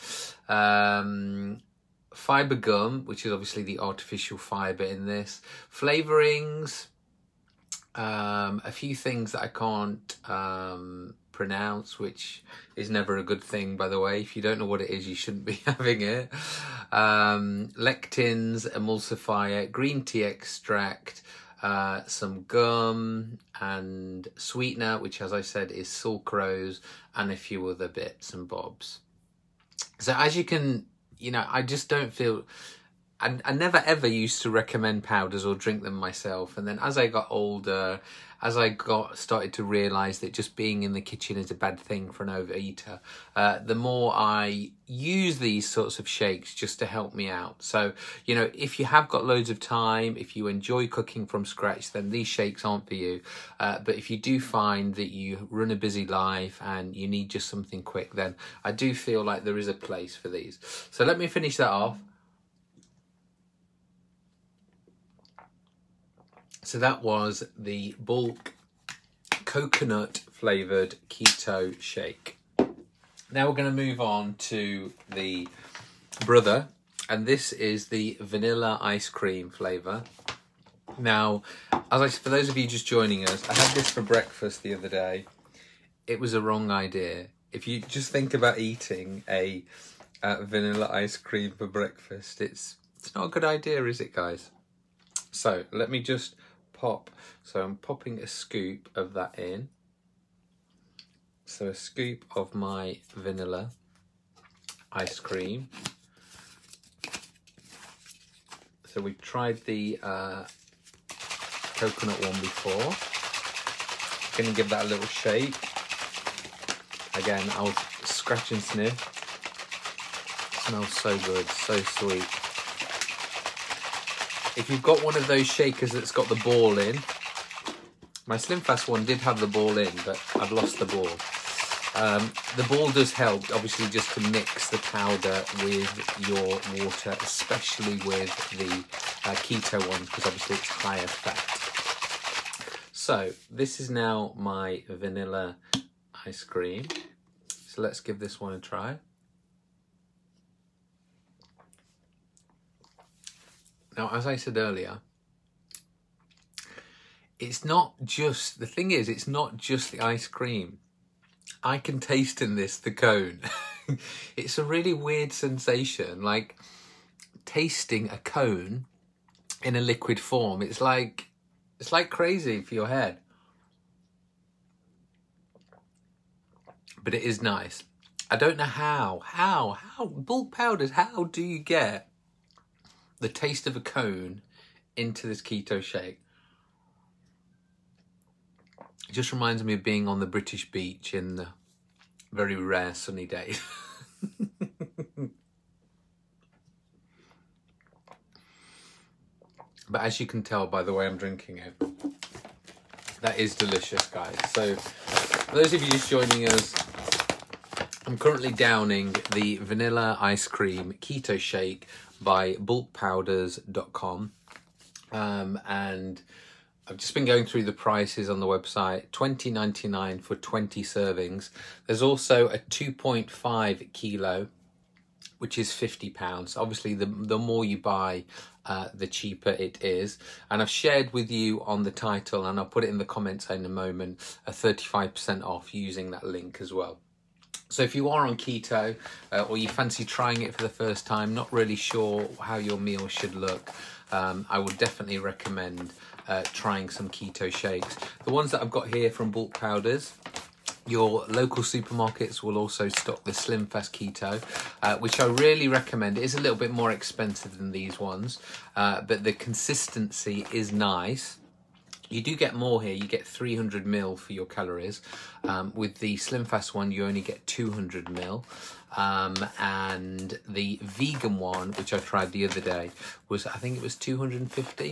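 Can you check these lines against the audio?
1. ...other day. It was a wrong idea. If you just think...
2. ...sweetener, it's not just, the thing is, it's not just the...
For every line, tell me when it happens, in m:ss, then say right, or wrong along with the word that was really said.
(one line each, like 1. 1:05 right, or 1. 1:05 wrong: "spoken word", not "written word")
1. 1:24 right
2. 2:34 wrong: "earlier", not "sweetener".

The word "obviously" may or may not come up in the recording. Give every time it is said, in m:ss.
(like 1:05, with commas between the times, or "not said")
0:03, 2:13, 2:20, 3:46.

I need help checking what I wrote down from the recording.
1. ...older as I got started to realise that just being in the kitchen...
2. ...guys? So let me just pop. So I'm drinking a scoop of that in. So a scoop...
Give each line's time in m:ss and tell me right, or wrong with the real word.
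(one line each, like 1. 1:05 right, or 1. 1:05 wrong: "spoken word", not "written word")
1. 0:37 right
2. 1:34 wrong: "popping", not "drinking".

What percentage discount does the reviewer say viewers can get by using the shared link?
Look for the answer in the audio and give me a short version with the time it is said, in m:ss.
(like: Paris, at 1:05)
35%, at 3:54.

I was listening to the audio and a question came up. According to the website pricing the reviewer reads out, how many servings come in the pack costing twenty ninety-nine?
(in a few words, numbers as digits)
20.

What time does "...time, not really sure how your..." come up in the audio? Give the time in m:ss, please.
4:01.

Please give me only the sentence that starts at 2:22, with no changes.
So this is now my vanilla ice cream.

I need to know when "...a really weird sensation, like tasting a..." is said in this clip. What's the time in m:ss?
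2:44.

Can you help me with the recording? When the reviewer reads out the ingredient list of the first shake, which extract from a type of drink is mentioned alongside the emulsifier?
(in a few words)
green tea extract.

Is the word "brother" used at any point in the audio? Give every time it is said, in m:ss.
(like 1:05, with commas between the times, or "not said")
1:16.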